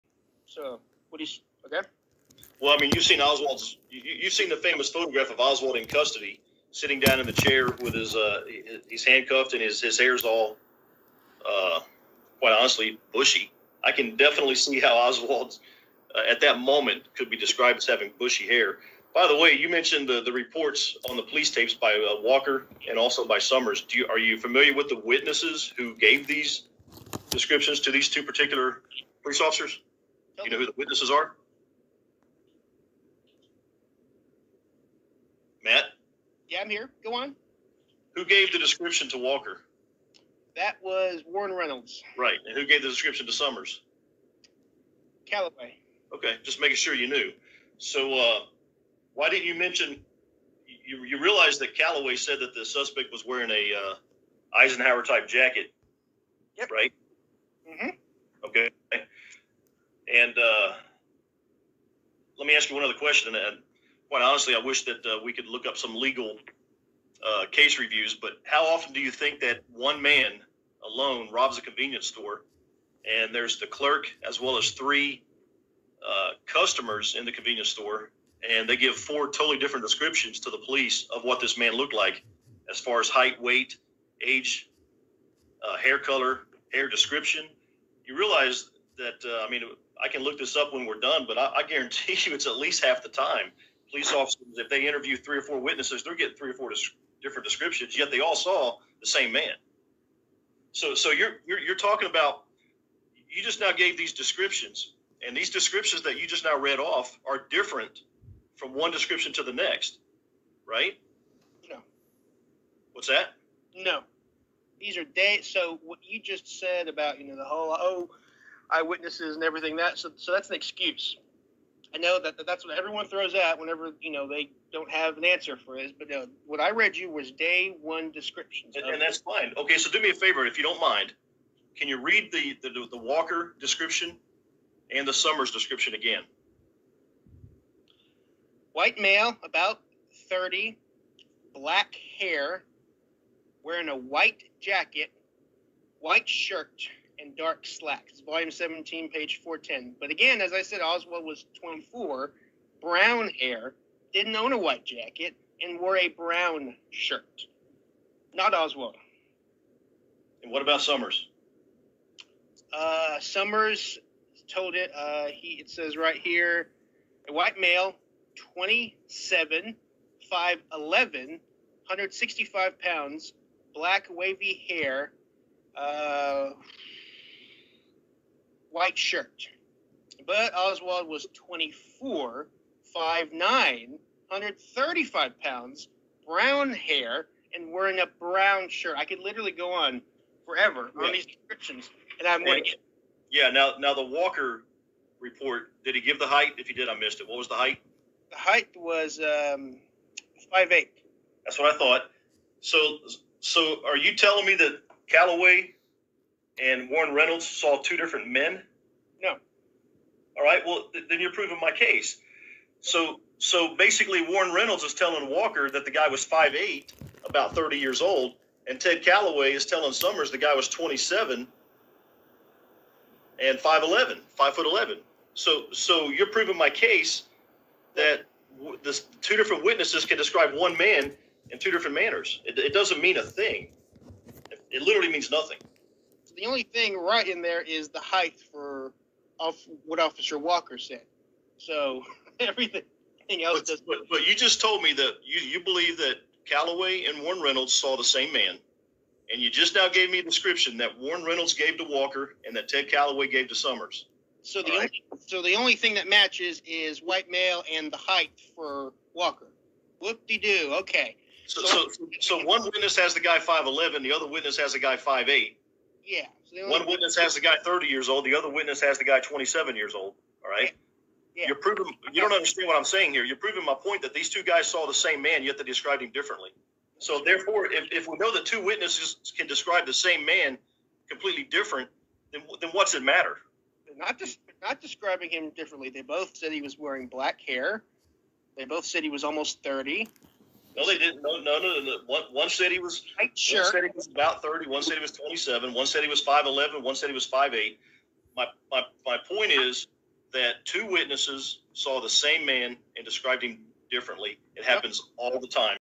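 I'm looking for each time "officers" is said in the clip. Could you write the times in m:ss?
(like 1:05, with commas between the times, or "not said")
0:29, 1:34, 3:59.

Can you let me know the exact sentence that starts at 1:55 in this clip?
So what you just said about you know the whole oh eyewitnesses and everything that.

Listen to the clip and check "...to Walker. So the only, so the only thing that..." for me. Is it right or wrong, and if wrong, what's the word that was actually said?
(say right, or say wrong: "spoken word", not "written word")
wrong: "Summers", not "Walker".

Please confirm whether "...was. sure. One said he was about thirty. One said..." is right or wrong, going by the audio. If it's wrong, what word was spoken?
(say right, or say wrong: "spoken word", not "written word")
right.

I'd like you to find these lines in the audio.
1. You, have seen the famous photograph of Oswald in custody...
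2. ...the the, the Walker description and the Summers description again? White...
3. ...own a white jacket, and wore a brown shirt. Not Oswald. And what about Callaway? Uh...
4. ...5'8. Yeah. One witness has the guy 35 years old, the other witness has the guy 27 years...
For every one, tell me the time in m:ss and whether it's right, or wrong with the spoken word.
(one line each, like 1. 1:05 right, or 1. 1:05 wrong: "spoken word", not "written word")
1. 0:03 right
2. 2:12 right
3. 2:34 wrong: "Summers", not "Callaway"
4. 4:24 wrong: "30", not "35".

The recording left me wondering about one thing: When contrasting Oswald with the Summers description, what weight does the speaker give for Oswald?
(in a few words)
135 pounds.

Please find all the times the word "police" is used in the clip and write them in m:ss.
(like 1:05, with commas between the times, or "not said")
0:21, 0:29, 1:20, 1:33.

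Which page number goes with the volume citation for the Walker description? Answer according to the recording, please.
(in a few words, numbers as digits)
410.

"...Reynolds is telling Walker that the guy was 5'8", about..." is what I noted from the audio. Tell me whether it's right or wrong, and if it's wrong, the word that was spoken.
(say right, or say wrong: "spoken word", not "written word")
right.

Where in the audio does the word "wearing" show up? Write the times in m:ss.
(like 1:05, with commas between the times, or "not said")
0:53, 2:23, 3:07, 4:46.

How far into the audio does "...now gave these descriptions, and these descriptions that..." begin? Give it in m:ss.
1:43.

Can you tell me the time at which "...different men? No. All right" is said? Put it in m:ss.
3:27.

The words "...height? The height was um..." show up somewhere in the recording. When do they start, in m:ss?
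3:17.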